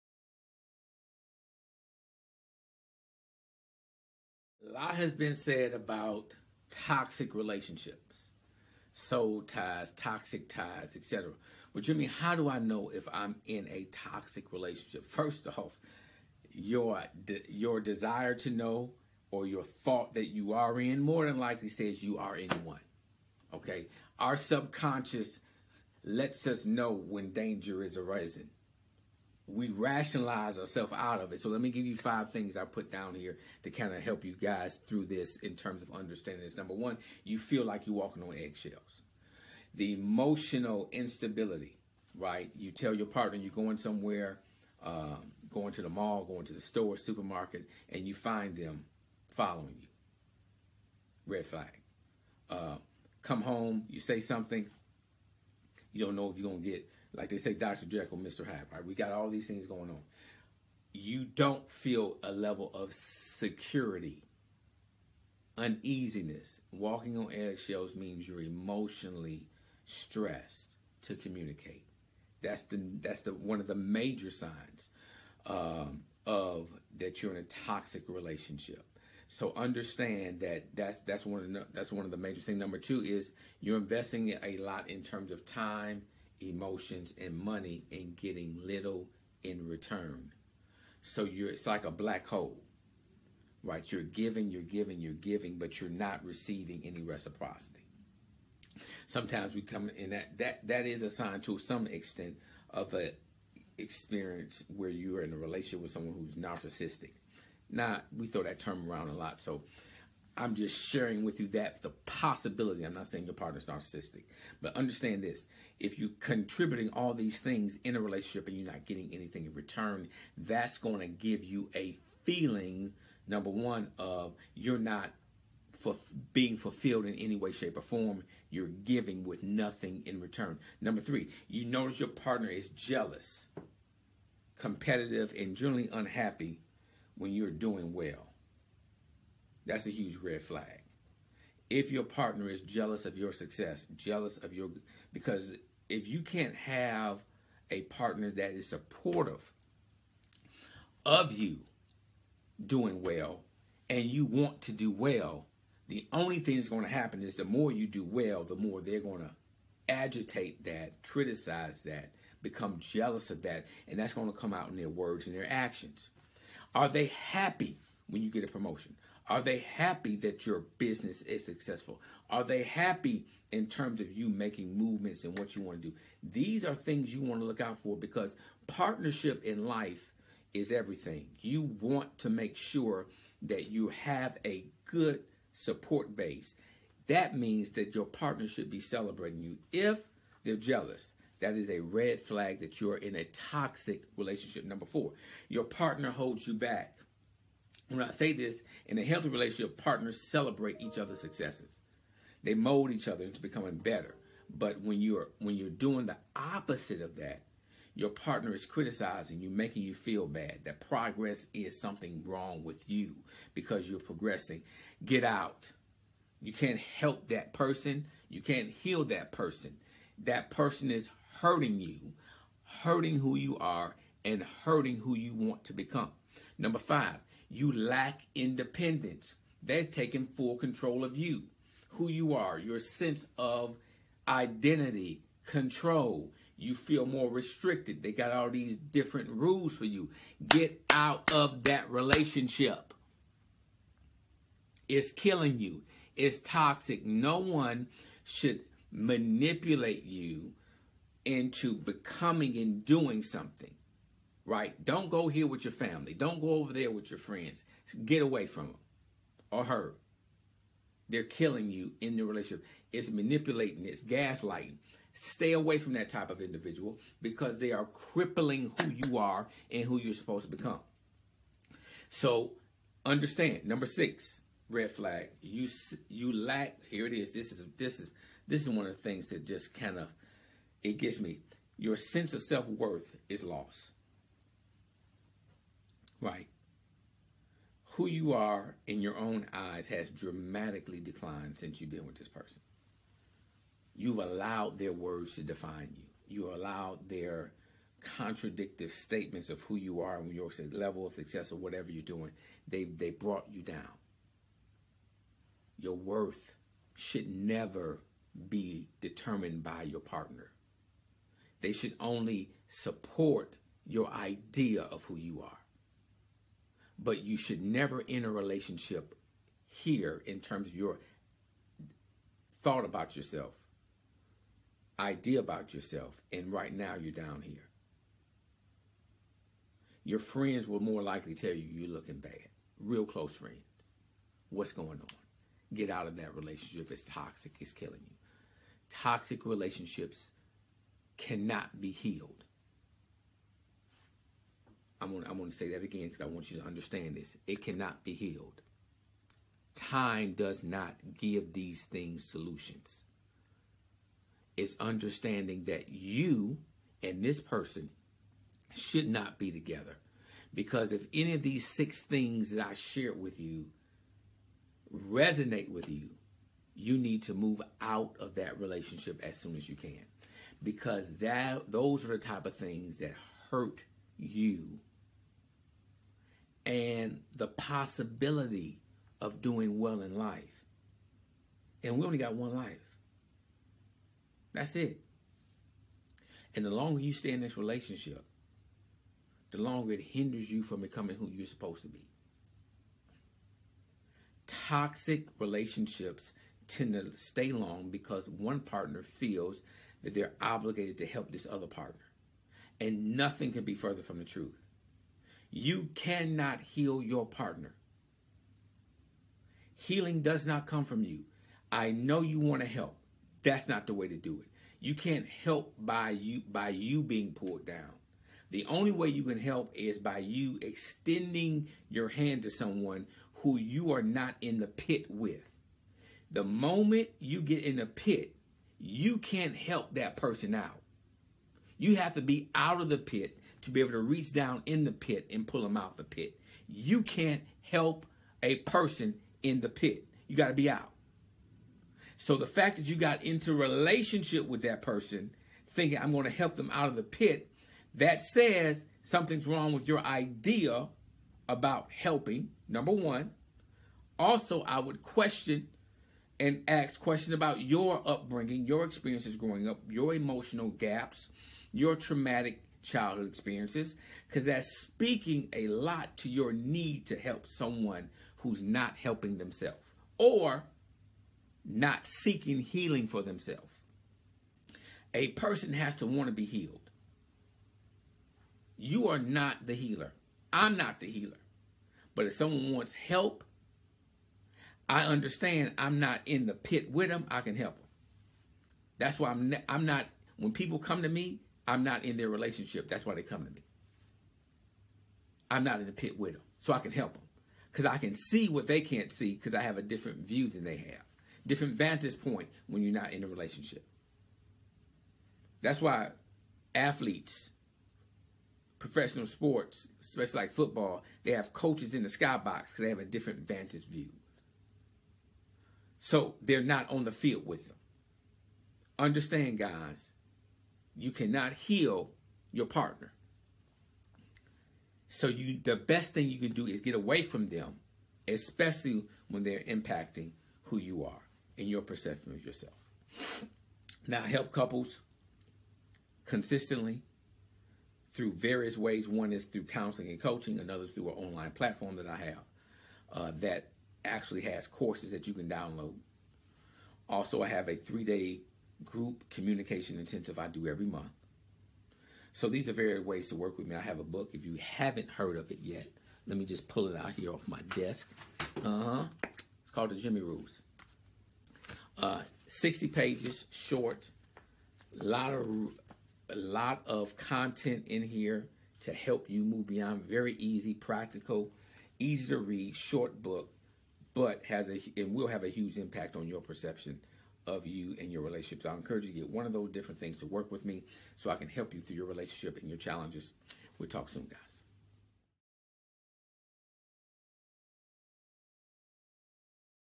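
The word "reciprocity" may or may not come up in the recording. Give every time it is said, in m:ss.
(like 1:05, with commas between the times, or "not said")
1:37.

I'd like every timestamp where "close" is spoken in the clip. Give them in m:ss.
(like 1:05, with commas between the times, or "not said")
5:33.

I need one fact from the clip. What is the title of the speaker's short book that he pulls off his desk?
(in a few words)
The Jimmy Rules.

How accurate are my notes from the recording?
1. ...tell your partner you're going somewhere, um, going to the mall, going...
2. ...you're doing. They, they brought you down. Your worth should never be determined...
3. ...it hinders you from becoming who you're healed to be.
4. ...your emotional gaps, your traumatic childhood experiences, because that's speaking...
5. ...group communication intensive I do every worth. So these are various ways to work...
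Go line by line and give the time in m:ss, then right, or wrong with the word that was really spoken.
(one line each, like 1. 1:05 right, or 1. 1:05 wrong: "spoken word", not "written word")
1. 0:42 right
2. 5:01 right
3. 6:29 wrong: "supposed", not "healed"
4. 7:39 right
5. 9:08 wrong: "month", not "worth".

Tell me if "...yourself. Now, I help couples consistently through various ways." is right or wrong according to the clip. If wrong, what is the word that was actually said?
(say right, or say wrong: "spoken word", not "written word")
right.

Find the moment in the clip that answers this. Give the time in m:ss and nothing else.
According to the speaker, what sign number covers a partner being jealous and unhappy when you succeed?
2:10.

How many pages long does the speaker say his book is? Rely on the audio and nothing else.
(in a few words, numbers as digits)
60.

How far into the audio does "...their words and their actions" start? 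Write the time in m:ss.
2:44.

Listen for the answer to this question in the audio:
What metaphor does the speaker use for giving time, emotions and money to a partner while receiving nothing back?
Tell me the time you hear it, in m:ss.
1:31.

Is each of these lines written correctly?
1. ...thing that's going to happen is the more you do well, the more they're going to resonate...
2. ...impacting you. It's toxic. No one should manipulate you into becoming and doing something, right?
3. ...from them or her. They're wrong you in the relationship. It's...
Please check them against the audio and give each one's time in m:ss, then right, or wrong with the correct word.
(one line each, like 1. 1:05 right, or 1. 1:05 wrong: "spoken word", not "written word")
1. 2:36 wrong: "agitate", not "resonate"
2. 4:05 wrong: "killing", not "impacting"
3. 4:18 wrong: "killing", not "wrong".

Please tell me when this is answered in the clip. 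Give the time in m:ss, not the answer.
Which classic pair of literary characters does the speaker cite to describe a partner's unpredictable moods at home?
0:57.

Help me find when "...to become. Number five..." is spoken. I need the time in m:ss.
3:45.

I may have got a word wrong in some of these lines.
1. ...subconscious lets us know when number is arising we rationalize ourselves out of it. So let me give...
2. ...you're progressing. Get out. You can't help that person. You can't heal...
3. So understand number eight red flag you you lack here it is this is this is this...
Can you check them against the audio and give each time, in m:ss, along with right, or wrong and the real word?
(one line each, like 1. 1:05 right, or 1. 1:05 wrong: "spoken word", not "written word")
1. 0:24 wrong: "danger", not "number"
2. 3:33 right
3. 4:32 wrong: "six", not "eight".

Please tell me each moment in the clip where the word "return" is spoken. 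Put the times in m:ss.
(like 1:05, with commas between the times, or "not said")
1:29, 1:59, 2:10.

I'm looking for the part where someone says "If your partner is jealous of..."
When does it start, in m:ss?
2:21.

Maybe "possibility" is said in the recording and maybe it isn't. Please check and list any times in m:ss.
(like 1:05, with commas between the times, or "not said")
1:52, 6:17.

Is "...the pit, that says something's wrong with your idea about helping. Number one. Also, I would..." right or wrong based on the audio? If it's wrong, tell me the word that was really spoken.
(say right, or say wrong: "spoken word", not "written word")
right.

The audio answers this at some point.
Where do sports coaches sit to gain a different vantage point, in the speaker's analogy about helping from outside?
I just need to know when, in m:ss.
8:32.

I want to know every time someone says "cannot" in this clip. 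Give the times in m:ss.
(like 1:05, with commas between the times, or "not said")
5:41, 5:47, 6:45, 8:41.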